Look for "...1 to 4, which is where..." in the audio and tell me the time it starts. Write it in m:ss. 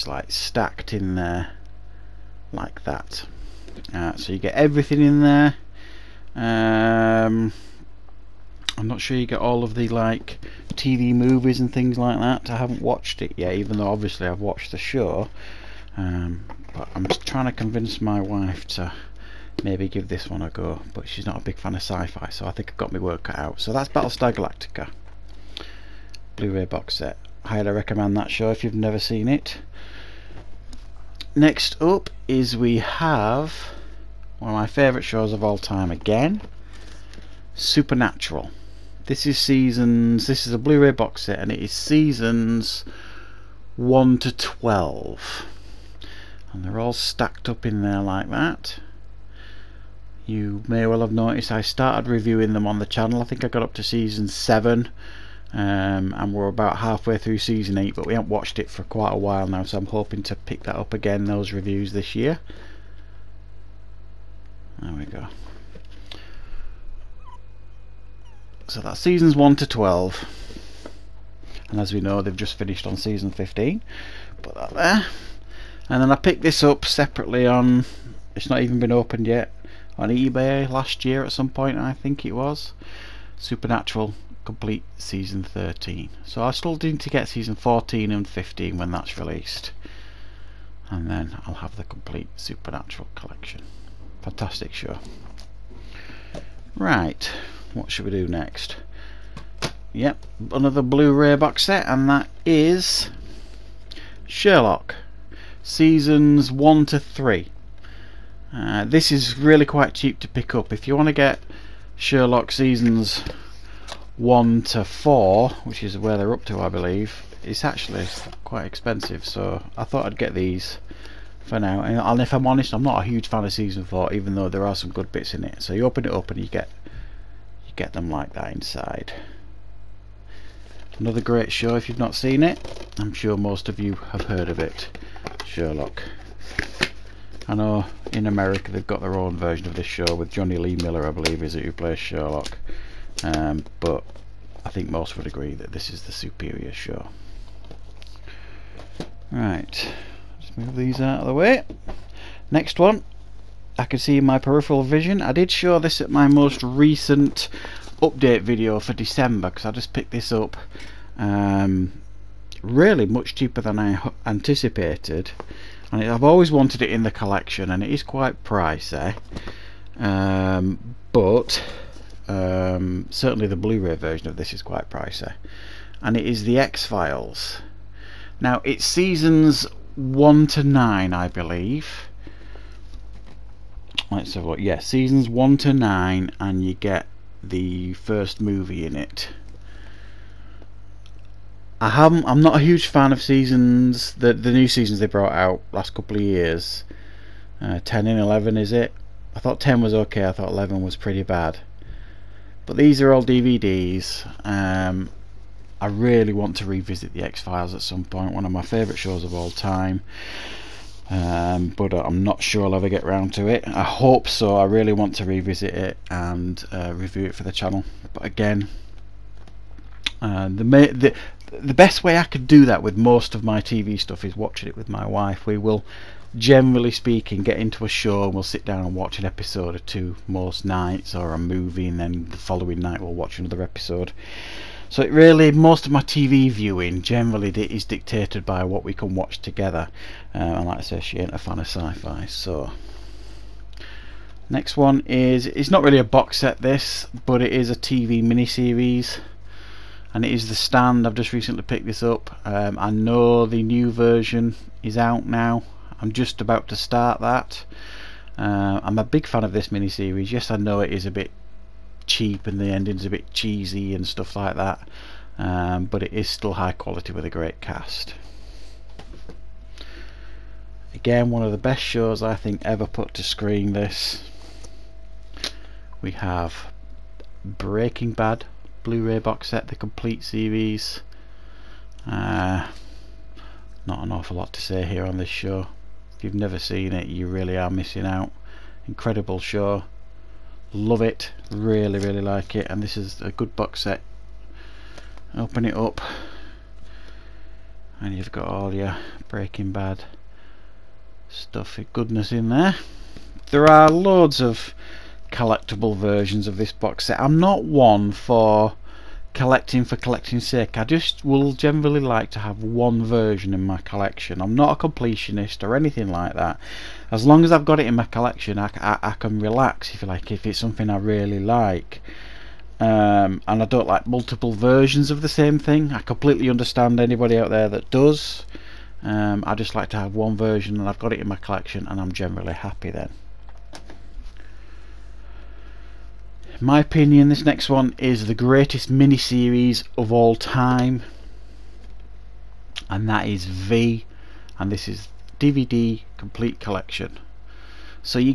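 1:54.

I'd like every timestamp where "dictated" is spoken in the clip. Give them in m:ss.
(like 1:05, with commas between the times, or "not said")
3:57.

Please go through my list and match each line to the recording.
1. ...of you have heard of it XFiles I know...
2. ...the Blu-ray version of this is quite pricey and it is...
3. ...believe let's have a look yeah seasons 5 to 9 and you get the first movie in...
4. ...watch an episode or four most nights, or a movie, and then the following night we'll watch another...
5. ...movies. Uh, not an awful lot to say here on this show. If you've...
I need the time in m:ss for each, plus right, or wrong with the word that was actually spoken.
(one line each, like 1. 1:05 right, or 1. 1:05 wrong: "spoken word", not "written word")
1. 2:13 wrong: "Sherlock", not "XFiles"
2. 2:53 right
3. 3:01 wrong: "1", not "5"
4. 3:48 wrong: "two", not "four"
5. 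4:40 wrong: "series", not "movies".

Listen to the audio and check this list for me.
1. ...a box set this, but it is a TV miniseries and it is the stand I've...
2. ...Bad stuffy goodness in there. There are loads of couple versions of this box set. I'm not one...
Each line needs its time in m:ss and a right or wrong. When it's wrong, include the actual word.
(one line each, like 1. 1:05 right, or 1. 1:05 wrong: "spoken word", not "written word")
1. 4:05 right
2. 4:59 wrong: "collectible", not "couple".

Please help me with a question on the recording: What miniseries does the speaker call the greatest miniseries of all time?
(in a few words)
V.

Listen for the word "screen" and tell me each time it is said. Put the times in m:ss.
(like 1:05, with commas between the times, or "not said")
4:33.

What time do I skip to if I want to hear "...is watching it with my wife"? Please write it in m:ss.
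3:44.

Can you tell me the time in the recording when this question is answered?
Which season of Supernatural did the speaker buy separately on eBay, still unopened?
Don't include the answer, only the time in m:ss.
1:24.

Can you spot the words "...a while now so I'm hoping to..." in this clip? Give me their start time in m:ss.
0:59.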